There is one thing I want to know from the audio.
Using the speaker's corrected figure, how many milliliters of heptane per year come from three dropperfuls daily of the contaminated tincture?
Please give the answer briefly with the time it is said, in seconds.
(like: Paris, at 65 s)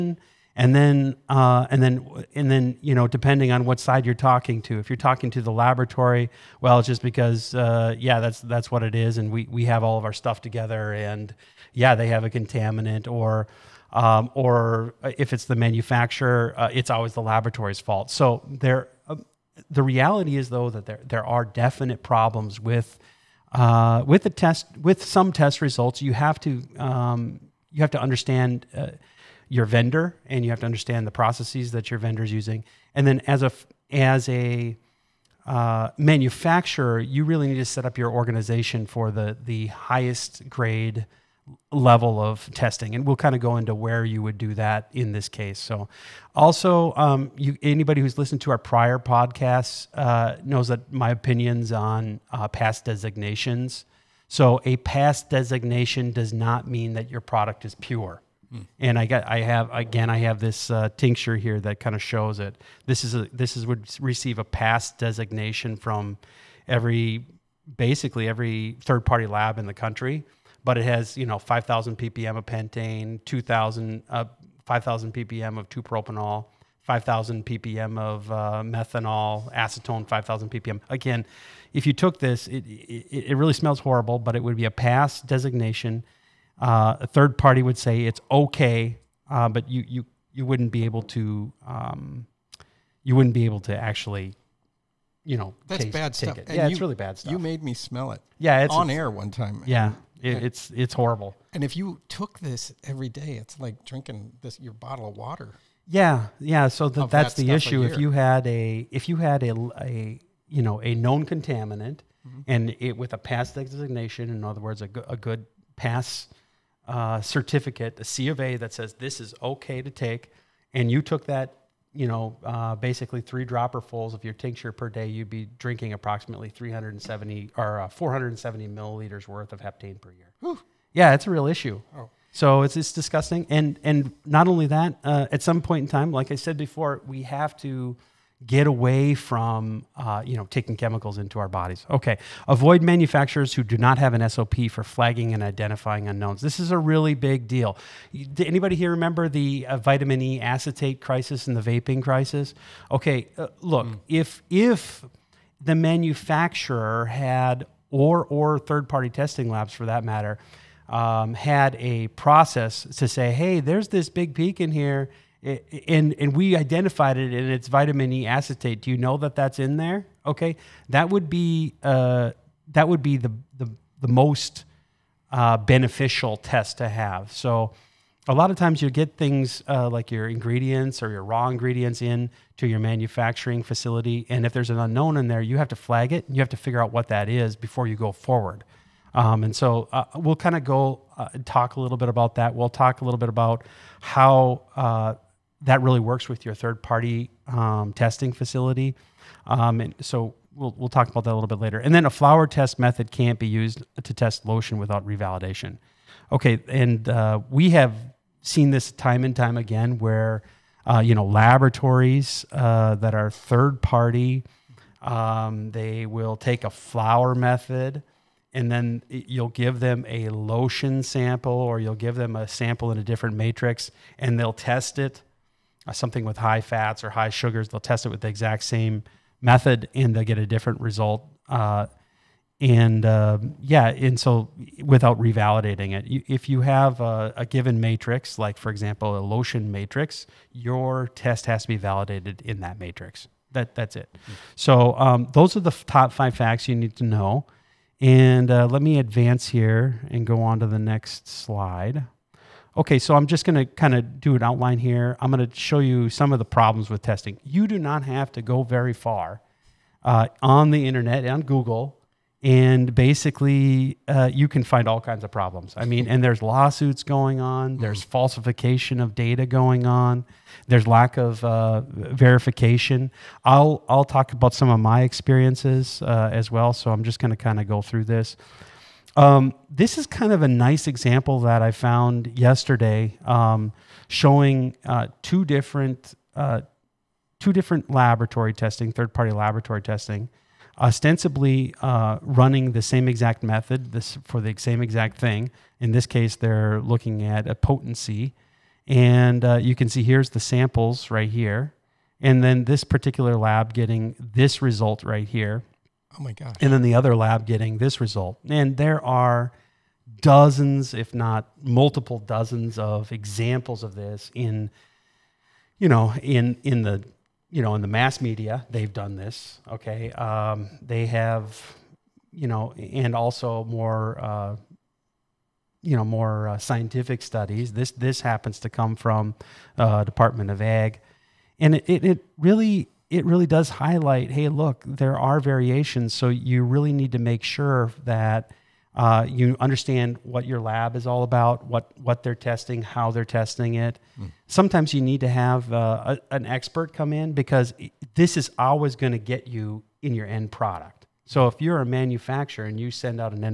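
470 milliliters, at 127 s.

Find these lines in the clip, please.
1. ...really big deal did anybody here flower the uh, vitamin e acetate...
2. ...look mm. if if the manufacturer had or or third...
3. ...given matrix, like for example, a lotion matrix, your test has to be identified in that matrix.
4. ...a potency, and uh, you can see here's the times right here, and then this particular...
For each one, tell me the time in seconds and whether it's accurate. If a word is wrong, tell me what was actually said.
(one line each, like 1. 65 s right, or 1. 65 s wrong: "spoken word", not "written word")
1. 146 s wrong: "remember", not "flower"
2. 153 s right
3. 237 s wrong: "validated", not "identified"
4. 297 s wrong: "samples", not "times".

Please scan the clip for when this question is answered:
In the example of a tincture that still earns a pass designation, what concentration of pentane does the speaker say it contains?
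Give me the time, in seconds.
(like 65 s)
71 s.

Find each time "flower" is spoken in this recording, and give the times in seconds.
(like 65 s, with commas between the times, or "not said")
202 s, 216 s.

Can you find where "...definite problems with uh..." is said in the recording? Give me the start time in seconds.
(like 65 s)
21 s.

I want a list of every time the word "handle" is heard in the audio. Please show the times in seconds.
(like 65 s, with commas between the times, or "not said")
not said.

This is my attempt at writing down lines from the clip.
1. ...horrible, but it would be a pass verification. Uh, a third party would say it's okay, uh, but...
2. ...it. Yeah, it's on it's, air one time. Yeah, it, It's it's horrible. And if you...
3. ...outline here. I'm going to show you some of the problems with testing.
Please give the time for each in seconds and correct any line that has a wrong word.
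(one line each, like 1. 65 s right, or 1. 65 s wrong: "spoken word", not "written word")
1. 83 s wrong: "designation", not "verification"
2. 98 s right
3. 254 s right.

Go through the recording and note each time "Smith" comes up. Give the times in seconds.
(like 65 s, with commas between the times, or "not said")
not said.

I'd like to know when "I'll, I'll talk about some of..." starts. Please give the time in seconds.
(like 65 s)
273 s.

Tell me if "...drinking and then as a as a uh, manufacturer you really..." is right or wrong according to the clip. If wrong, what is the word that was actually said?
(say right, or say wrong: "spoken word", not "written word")
wrong: "using", not "drinking".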